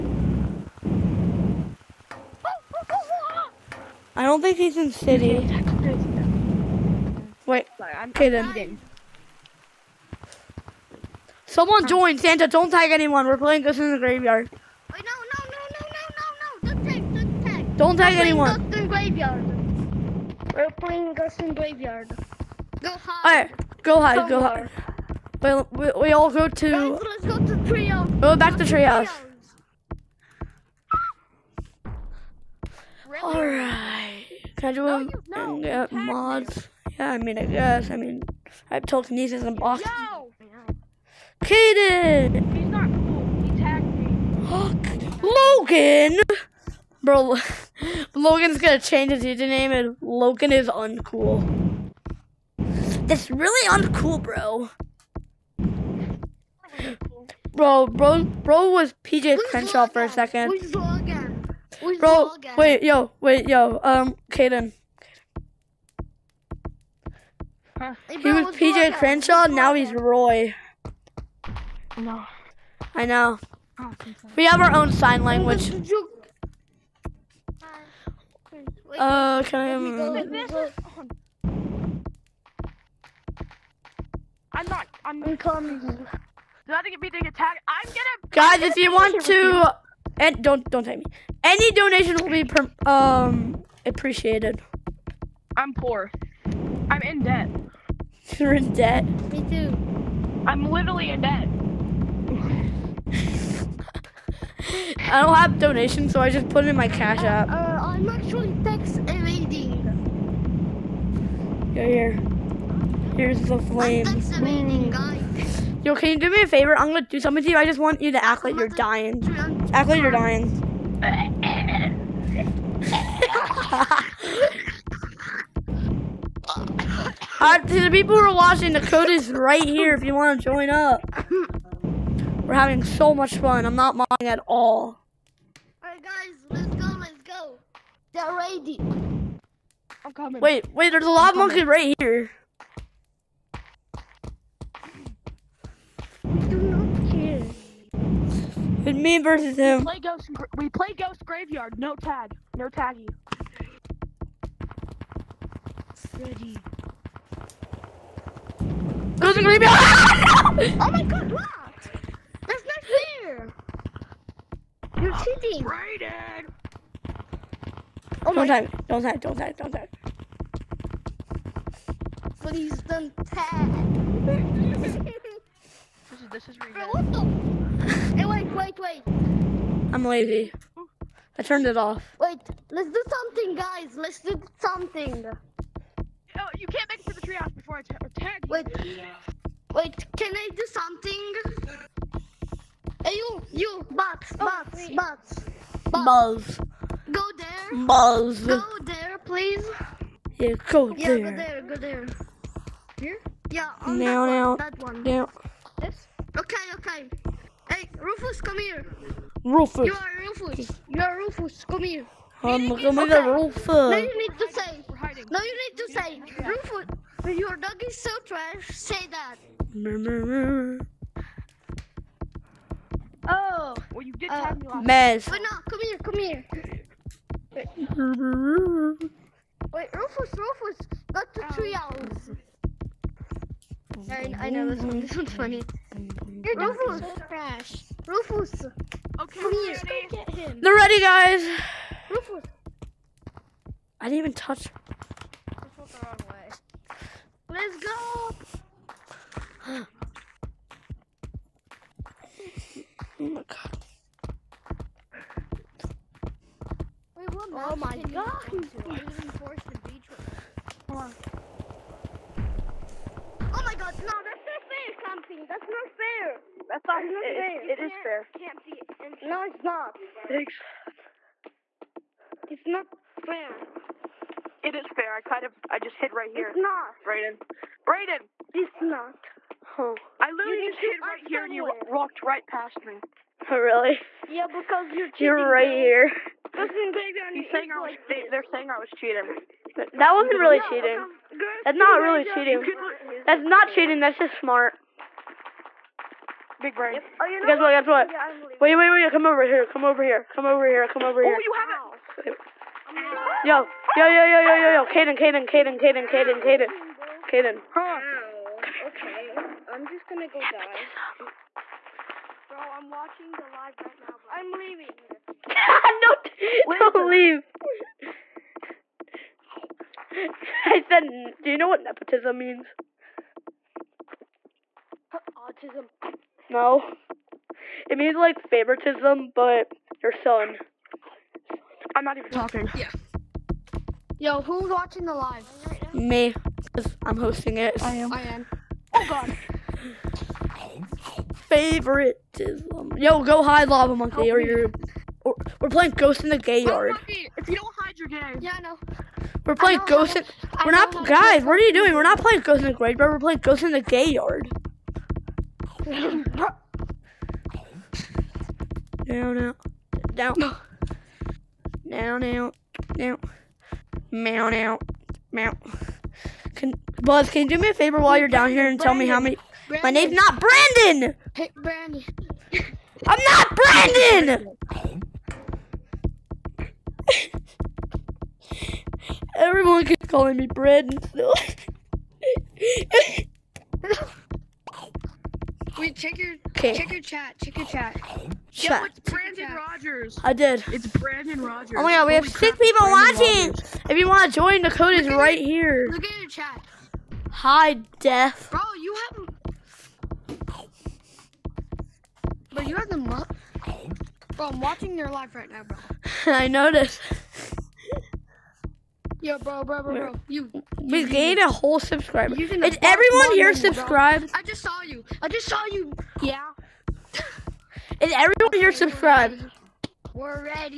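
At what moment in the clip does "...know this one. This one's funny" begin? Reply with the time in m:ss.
3:54.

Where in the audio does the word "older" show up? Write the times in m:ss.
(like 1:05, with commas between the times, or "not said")
not said.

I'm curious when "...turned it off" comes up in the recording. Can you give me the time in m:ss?
3:01.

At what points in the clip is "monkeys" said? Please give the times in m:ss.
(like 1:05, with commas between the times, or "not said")
2:21, 5:43.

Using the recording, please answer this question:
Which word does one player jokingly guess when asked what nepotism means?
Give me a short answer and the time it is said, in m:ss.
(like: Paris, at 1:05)
Autism, at 5:25.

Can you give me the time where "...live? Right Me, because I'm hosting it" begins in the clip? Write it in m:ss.
5:35.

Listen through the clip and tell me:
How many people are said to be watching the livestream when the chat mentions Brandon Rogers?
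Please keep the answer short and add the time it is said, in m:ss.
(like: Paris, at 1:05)
6, at 6:32.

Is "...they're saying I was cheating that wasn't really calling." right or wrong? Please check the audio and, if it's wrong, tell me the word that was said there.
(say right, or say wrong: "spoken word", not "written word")
wrong: "cheating", not "calling".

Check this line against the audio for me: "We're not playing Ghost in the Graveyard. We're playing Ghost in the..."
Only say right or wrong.
right.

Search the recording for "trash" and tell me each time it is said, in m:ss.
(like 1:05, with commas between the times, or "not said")
3:38, 3:57.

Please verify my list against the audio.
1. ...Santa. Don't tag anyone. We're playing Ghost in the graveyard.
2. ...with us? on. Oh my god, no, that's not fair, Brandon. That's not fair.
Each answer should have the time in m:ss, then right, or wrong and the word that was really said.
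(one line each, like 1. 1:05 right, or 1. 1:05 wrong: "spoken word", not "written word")
1. 0:12 right
2. 4:20 wrong: "Campy", not "Brandon".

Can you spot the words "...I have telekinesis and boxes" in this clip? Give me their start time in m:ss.
0:38.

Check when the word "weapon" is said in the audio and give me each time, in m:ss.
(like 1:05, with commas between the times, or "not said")
not said.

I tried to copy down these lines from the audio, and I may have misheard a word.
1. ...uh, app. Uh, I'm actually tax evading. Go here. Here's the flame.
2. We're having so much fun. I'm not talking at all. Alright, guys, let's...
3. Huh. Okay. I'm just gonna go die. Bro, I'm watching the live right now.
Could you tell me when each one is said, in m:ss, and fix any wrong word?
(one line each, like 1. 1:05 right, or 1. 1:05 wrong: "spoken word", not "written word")
1. 1:47 right
2. 2:12 wrong: "modding", not "talking"
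3. 5:07 right.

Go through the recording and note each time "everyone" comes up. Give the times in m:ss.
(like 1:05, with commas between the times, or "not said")
6:19, 6:52, 6:58.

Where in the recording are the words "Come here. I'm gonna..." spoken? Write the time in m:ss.
3:31.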